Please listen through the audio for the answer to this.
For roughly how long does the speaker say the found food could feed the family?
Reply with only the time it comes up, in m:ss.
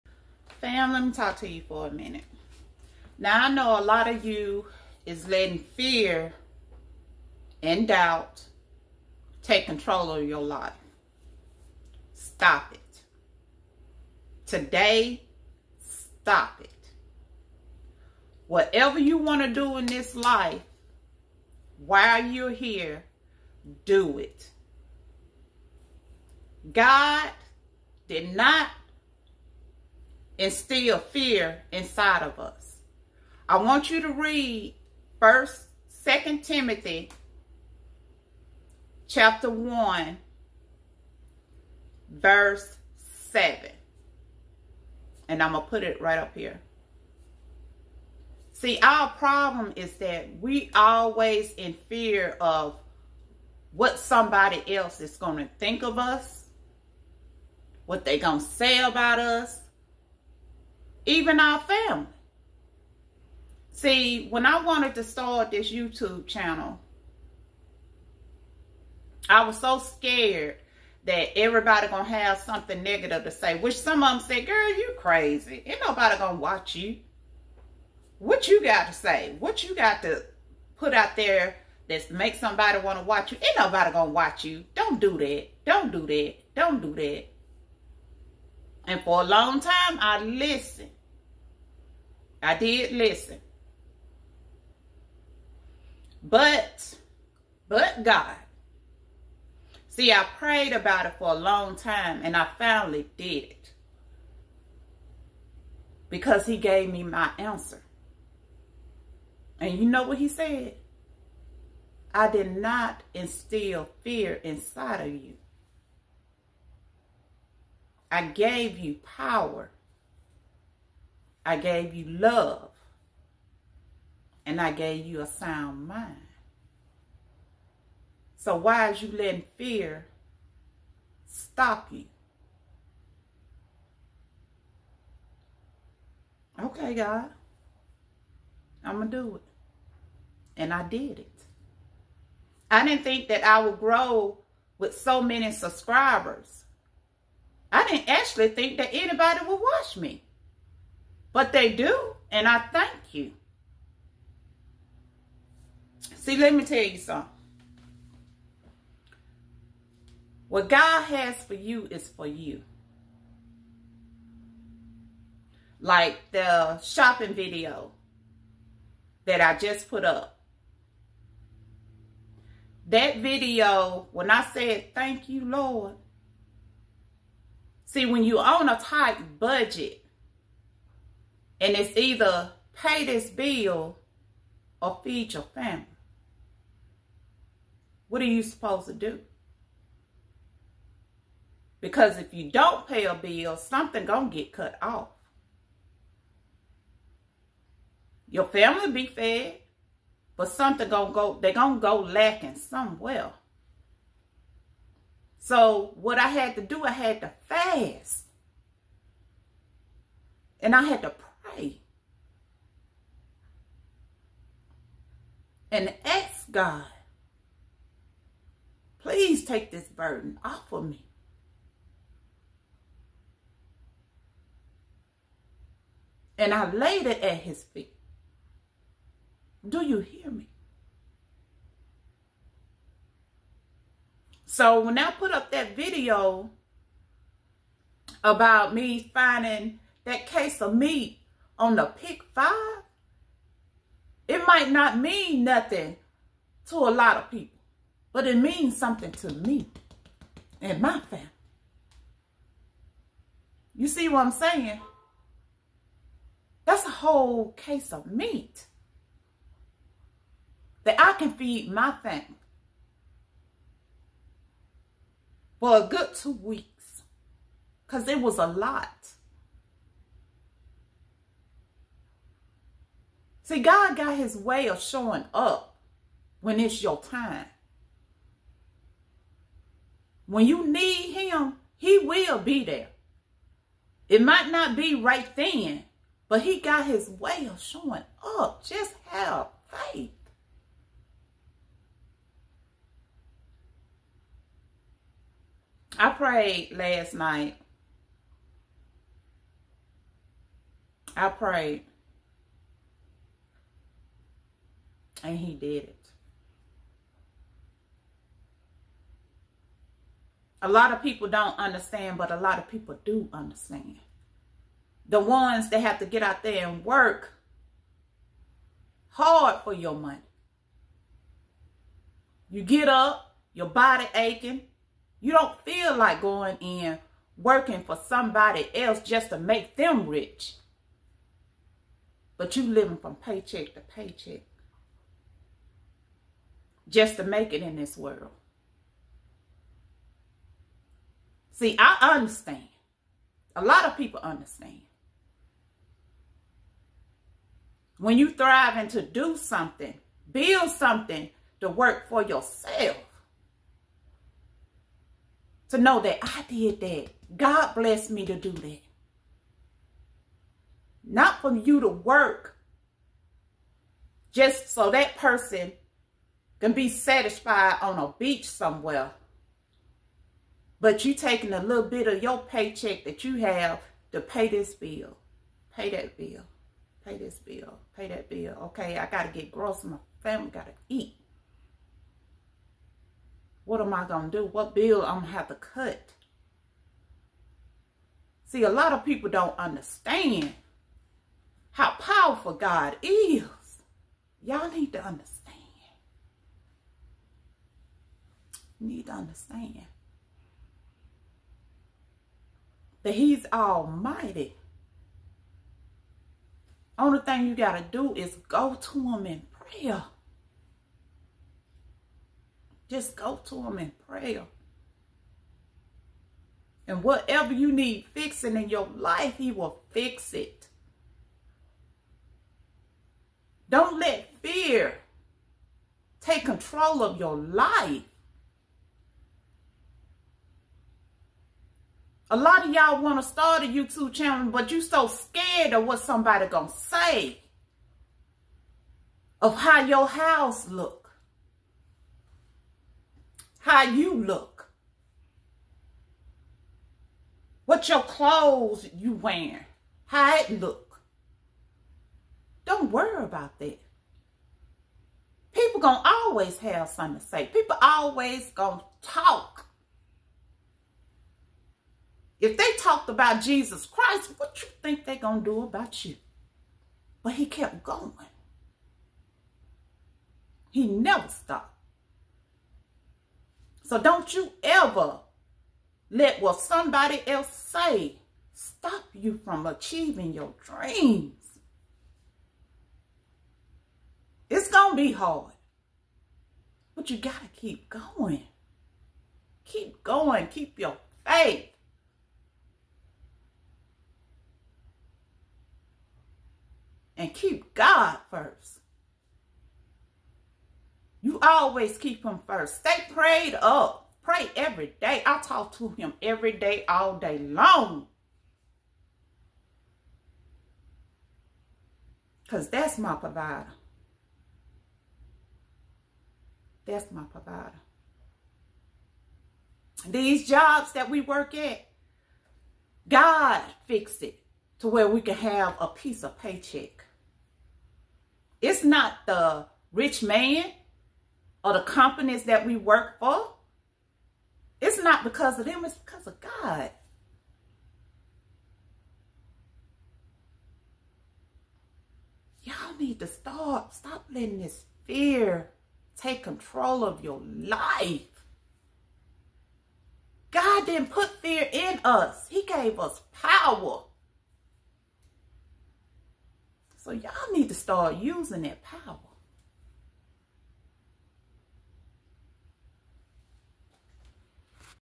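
4:26.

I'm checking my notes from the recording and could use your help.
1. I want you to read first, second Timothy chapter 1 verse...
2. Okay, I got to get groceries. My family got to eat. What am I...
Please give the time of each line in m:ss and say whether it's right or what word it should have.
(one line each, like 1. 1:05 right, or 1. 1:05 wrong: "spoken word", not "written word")
1. 0:33 right
2. 6:18 right.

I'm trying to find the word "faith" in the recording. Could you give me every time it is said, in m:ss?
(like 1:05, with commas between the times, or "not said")
4:49, 8:11.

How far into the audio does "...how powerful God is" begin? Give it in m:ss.
6:31.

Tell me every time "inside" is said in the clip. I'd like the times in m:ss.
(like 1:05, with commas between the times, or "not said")
0:31, 1:54.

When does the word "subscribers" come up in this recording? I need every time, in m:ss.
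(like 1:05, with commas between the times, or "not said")
2:25.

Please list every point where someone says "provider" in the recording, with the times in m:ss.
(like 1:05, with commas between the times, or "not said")
8:33, 8:37.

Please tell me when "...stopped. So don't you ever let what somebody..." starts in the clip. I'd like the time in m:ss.
7:51.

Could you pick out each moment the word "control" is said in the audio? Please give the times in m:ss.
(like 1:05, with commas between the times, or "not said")
0:09, 7:06, 9:06.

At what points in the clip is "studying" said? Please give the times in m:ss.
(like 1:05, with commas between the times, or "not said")
not said.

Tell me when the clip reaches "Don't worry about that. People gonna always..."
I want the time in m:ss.
7:32.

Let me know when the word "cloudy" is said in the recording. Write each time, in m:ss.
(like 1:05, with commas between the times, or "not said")
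not said.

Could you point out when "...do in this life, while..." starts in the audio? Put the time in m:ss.
0:19.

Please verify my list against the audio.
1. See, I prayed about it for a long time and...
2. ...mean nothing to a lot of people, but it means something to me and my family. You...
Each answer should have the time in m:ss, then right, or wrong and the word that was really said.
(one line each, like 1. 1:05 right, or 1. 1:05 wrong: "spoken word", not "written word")
1. 1:39 right
2. 4:04 right.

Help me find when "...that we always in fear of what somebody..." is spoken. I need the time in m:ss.
0:49.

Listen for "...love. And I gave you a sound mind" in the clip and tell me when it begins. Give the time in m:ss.
2:02.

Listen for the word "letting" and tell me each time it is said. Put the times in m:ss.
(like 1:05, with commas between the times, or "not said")
0:05, 2:09, 9:04.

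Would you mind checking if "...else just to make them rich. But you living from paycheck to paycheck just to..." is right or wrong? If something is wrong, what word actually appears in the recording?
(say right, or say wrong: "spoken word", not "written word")
right.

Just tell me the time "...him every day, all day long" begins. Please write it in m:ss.
8:25.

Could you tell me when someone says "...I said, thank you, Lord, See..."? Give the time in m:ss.
2:54.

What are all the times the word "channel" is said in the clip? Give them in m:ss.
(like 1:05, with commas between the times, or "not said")
1:06, 7:14.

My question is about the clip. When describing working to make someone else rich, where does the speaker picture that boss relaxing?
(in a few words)
On a beach.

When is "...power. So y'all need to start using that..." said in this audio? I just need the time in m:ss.
9:13.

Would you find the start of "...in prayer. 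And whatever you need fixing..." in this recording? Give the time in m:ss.
6:53.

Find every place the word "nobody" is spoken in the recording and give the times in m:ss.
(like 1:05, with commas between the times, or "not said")
1:15, 1:23.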